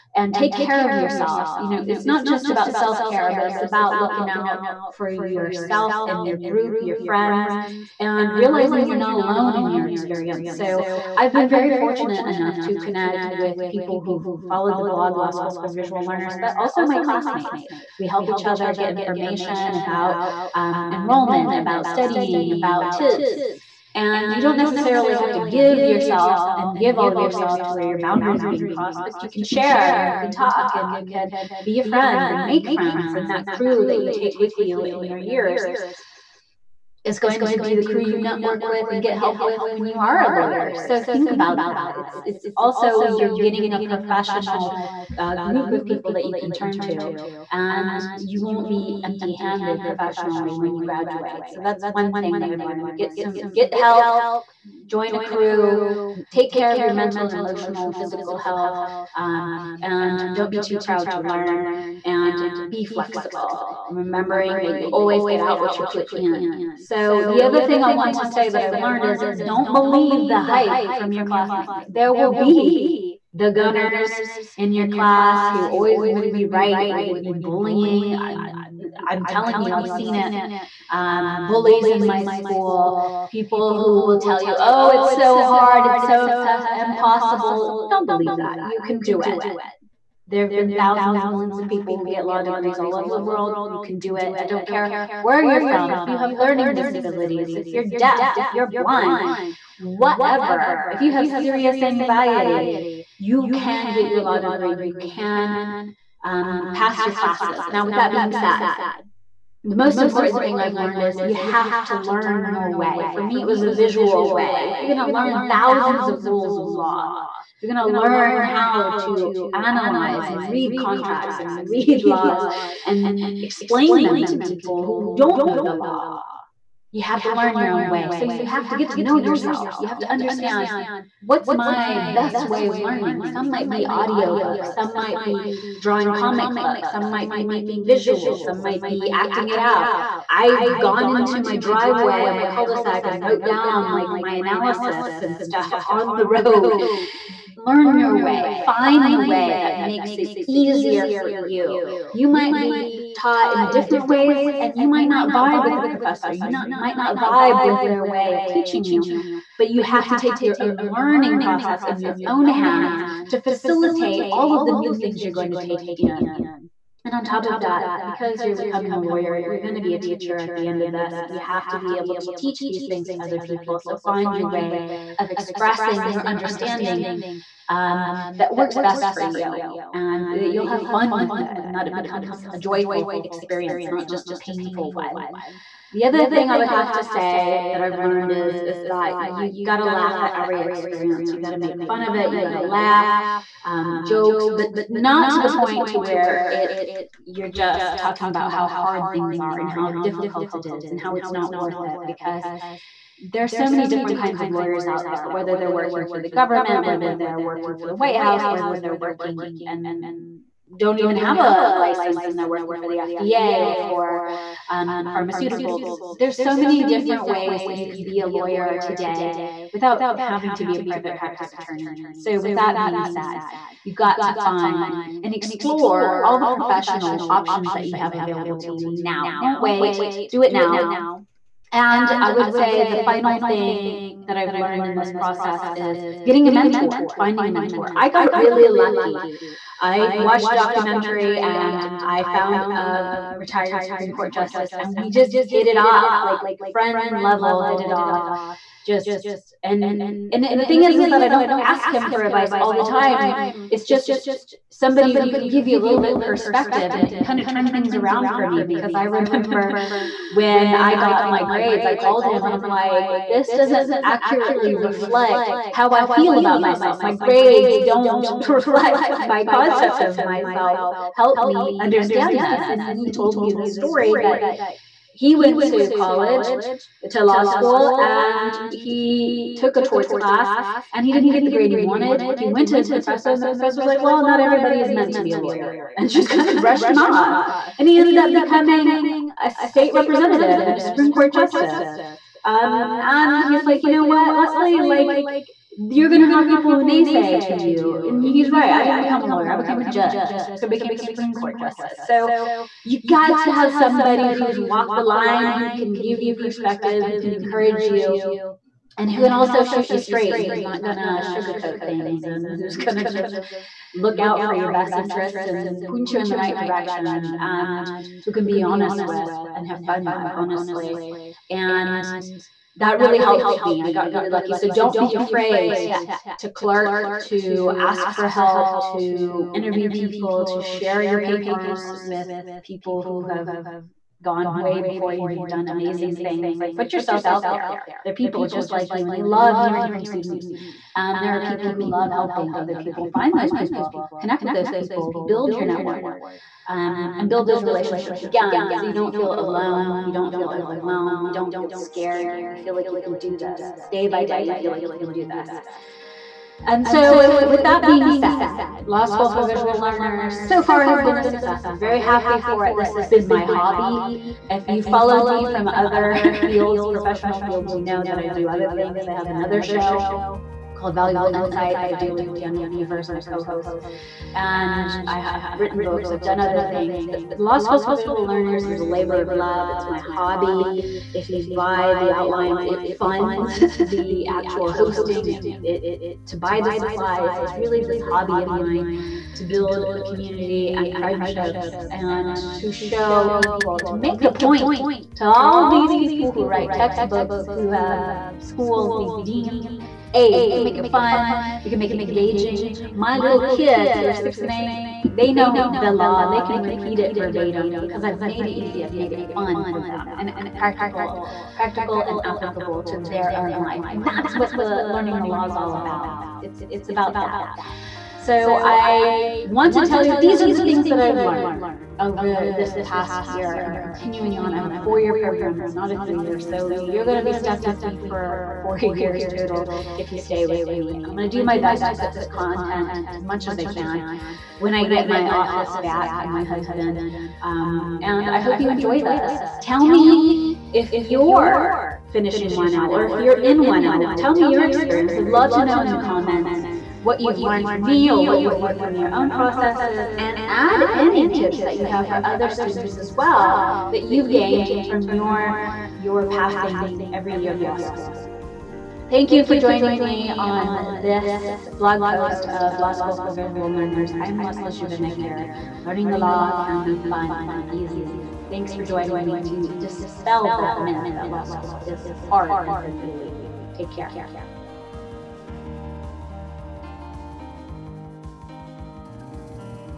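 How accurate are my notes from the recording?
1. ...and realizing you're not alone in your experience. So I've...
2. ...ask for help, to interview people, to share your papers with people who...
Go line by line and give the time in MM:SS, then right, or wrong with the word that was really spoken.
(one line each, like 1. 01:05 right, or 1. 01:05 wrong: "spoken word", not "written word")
1. 00:07 right
2. 05:27 right.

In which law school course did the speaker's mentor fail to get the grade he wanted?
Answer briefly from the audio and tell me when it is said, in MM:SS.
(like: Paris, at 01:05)
torts, at 04:39.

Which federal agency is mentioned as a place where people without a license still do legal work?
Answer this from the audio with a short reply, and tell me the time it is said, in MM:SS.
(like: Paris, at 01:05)
FDA, at 03:33.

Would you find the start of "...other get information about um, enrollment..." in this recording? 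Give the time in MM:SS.
00:18.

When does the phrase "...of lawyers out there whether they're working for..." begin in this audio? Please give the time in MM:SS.
03:24.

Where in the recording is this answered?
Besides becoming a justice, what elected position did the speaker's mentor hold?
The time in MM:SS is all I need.
04:49.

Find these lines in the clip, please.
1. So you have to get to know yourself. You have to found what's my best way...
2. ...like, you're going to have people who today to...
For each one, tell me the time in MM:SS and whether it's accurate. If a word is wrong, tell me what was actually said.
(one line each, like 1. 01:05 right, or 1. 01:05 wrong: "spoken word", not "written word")
1. 02:08 wrong: "understand", not "found"
2. 04:54 wrong: "naysay", not "today".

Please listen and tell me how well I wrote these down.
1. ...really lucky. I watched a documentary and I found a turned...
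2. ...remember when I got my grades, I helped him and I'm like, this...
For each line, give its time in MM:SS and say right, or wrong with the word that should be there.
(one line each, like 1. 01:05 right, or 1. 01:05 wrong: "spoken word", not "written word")
1. 03:58 wrong: "retired", not "turned"
2. 04:19 wrong: "called", not "helped".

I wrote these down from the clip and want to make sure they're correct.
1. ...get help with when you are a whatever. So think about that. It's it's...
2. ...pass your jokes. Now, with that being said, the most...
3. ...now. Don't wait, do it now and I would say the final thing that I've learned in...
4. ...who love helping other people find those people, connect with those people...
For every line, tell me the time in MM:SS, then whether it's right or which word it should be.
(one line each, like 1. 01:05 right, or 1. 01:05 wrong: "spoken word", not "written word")
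1. 00:39 wrong: "lawyer", not "whatever"
2. 01:46 wrong: "classes", not "jokes"
3. 03:48 right
4. 05:41 right.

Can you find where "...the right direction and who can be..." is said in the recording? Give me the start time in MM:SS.
05:16.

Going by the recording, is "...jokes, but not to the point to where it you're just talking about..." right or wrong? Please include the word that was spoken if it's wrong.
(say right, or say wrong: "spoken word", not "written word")
right.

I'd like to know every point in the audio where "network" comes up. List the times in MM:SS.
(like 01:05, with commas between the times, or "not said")
00:38, 05:45.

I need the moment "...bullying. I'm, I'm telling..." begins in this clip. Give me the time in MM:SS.
01:17.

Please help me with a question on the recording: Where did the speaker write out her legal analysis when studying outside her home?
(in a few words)
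on the road.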